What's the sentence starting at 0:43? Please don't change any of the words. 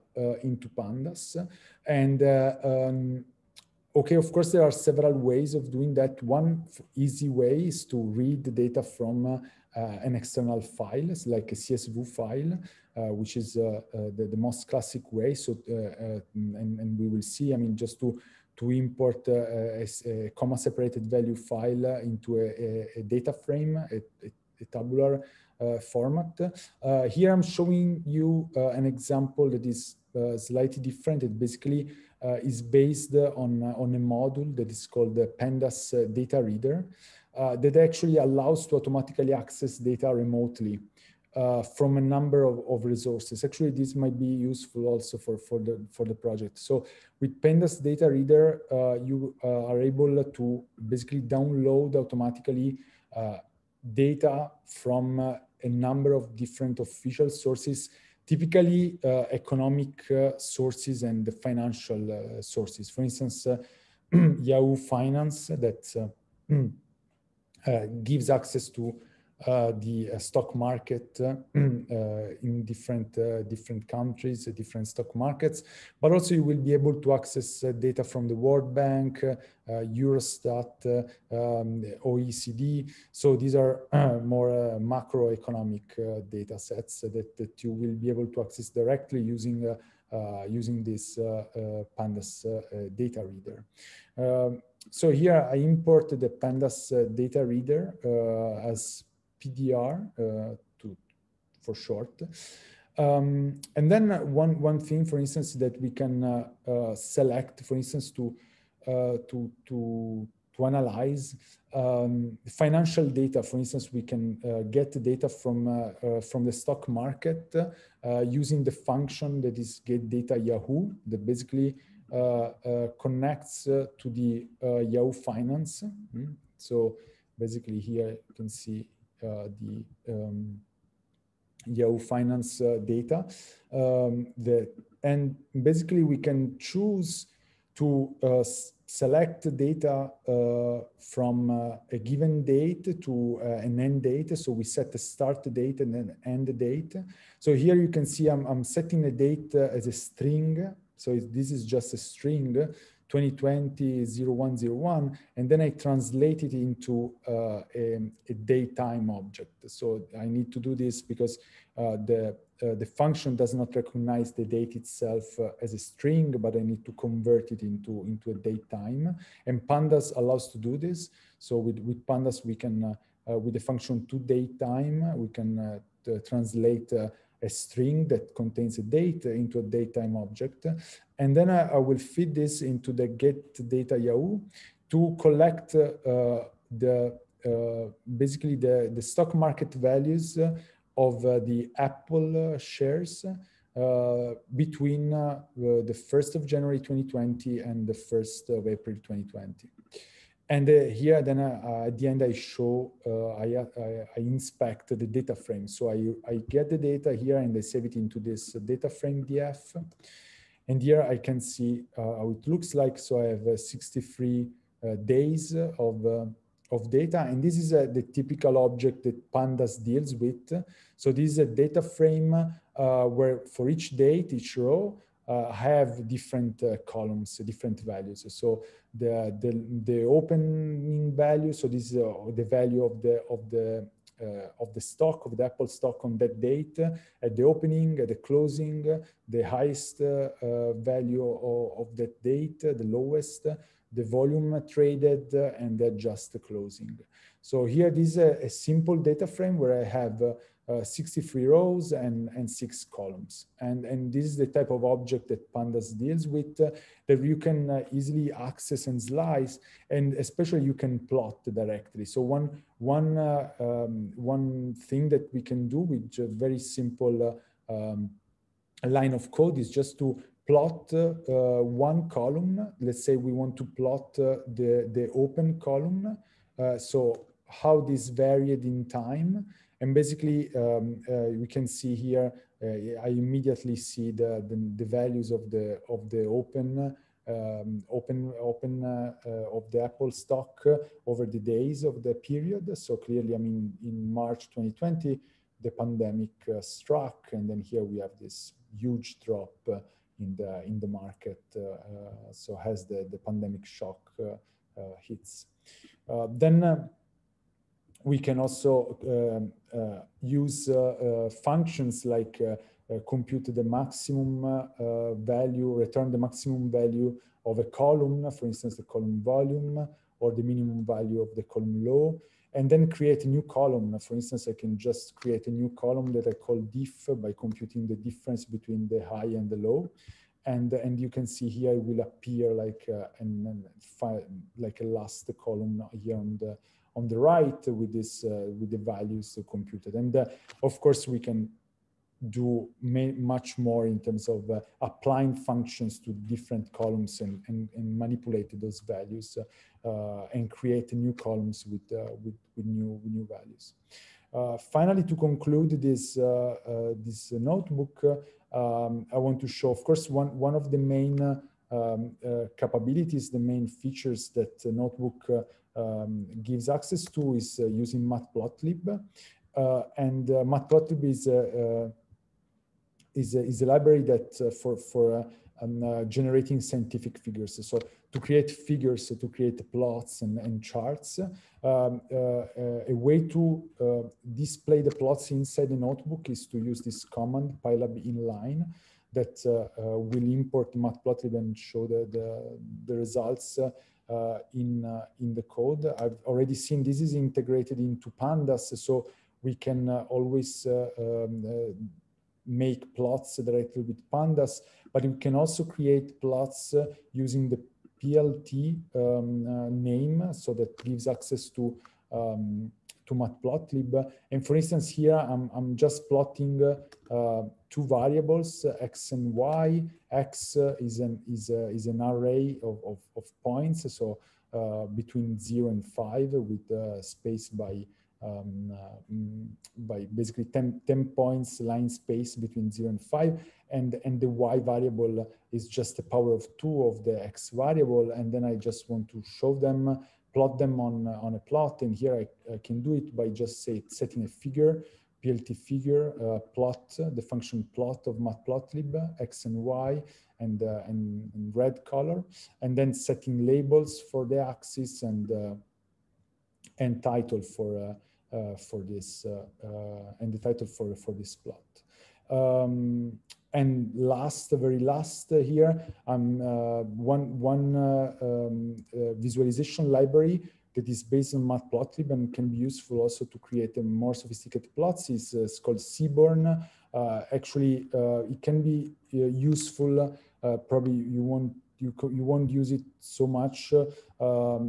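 Actually, this might be useful also for, for, the, for the project.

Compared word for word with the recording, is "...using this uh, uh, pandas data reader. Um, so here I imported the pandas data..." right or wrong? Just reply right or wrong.
right.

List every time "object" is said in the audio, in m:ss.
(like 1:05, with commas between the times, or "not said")
2:39, 3:00, 3:38, 4:14.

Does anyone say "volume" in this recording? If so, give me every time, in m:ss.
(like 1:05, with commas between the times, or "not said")
4:04, 5:19.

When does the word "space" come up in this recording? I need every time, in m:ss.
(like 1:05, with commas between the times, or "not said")
7:07, 7:11.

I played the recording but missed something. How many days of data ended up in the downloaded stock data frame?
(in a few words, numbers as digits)
63.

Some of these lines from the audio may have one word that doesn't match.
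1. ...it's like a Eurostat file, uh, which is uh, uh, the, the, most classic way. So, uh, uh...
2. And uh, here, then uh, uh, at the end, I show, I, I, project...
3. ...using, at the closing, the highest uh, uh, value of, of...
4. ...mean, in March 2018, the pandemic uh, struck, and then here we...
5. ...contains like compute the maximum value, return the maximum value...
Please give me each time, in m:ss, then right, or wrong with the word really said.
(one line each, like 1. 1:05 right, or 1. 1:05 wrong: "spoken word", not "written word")
1. 0:11 wrong: "CSV", not "Eurostat"
2. 3:20 wrong: "inspect", not "project"
3. 3:57 wrong: "opening", not "using"
4. 4:53 wrong: "2020", not "2018"
5. 5:11 wrong: "functions", not "contains".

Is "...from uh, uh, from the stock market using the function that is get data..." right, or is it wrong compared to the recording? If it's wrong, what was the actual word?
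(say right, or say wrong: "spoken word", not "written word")
right.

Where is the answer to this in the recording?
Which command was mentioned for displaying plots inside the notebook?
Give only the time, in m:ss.
6:27.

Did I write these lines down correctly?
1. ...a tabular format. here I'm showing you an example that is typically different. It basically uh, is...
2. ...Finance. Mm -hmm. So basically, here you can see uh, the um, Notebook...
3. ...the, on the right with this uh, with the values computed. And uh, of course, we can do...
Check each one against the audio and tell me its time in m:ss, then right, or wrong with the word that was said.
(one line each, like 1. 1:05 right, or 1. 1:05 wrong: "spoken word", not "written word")
1. 0:24 wrong: "slightly", not "typically"
2. 2:05 wrong: "Yahoo", not "Notebook"
3. 5:36 right.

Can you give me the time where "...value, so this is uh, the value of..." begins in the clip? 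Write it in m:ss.
3:51.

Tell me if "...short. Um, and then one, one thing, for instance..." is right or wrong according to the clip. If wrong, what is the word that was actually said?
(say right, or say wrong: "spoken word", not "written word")
right.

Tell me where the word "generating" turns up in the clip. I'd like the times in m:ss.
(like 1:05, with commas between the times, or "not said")
6:16.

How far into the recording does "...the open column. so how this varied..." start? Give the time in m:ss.
4:34.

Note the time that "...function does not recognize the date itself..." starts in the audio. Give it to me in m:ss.
2:42.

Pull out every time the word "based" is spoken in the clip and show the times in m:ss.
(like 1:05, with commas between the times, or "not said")
0:32, 7:51.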